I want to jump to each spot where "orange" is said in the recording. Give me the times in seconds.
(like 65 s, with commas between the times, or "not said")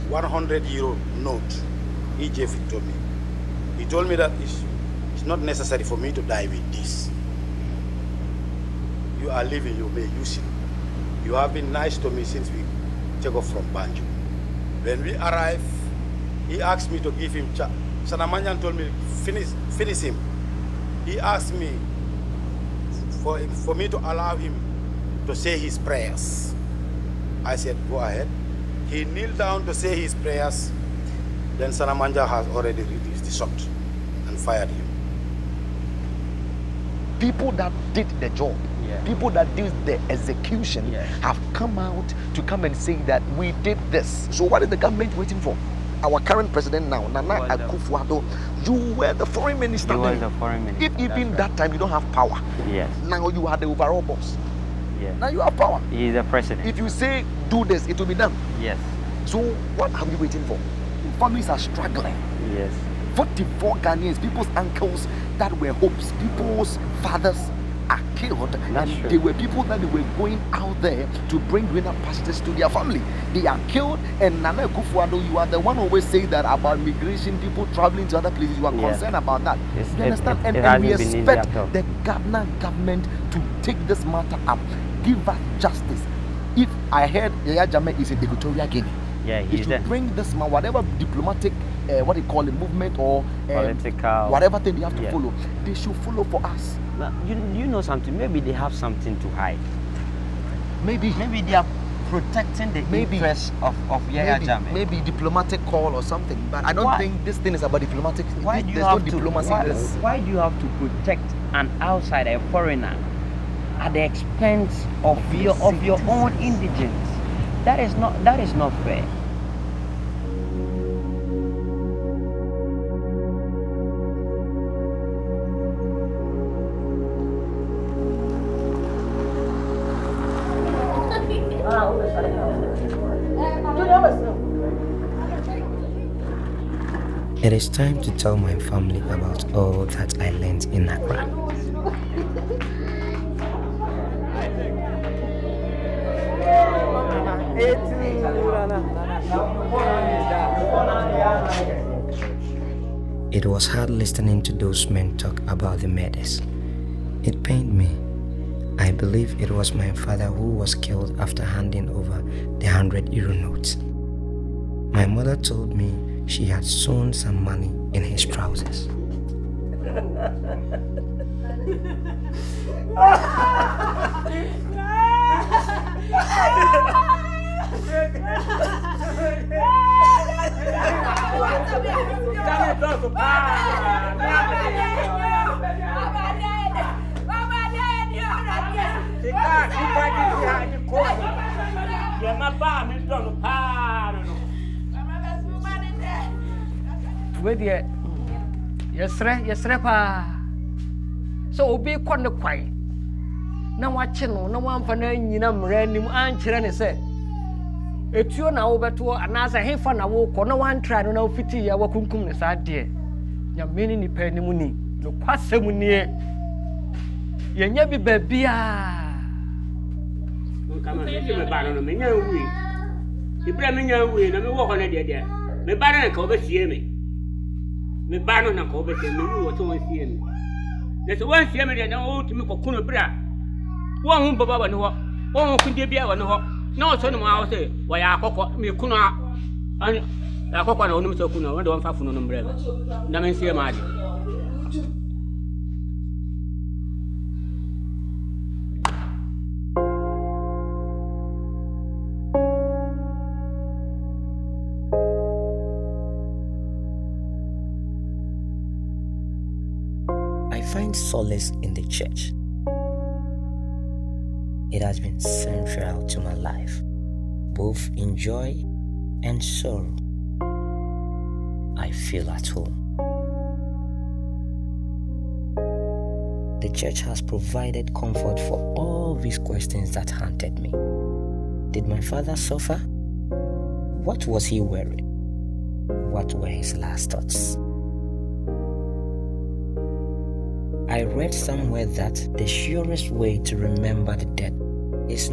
not said.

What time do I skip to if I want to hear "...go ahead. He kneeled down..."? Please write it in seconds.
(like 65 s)
27 s.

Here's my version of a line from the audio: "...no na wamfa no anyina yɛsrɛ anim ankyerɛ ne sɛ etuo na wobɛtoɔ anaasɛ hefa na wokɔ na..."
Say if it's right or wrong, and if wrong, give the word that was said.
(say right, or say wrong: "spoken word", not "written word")
wrong: "mmerɛ", not "yɛsrɛ".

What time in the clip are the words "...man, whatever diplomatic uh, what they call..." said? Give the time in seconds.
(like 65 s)
90 s.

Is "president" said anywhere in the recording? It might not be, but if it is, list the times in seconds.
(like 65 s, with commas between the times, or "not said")
46 s, 56 s.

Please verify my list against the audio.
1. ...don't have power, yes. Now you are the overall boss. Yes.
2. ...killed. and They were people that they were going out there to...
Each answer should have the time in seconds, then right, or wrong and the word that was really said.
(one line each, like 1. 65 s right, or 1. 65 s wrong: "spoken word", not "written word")
1. 51 s right
2. 68 s right.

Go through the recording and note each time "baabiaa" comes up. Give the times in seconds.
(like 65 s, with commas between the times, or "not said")
217 s.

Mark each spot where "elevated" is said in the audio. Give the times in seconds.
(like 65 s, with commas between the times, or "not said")
not said.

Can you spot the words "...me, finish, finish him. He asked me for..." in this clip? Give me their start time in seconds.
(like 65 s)
18 s.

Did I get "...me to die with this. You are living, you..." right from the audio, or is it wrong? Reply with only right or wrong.
right.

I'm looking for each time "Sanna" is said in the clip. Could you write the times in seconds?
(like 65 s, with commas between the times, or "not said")
18 s, 31 s.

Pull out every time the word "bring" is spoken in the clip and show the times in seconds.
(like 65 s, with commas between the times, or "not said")
71 s, 89 s.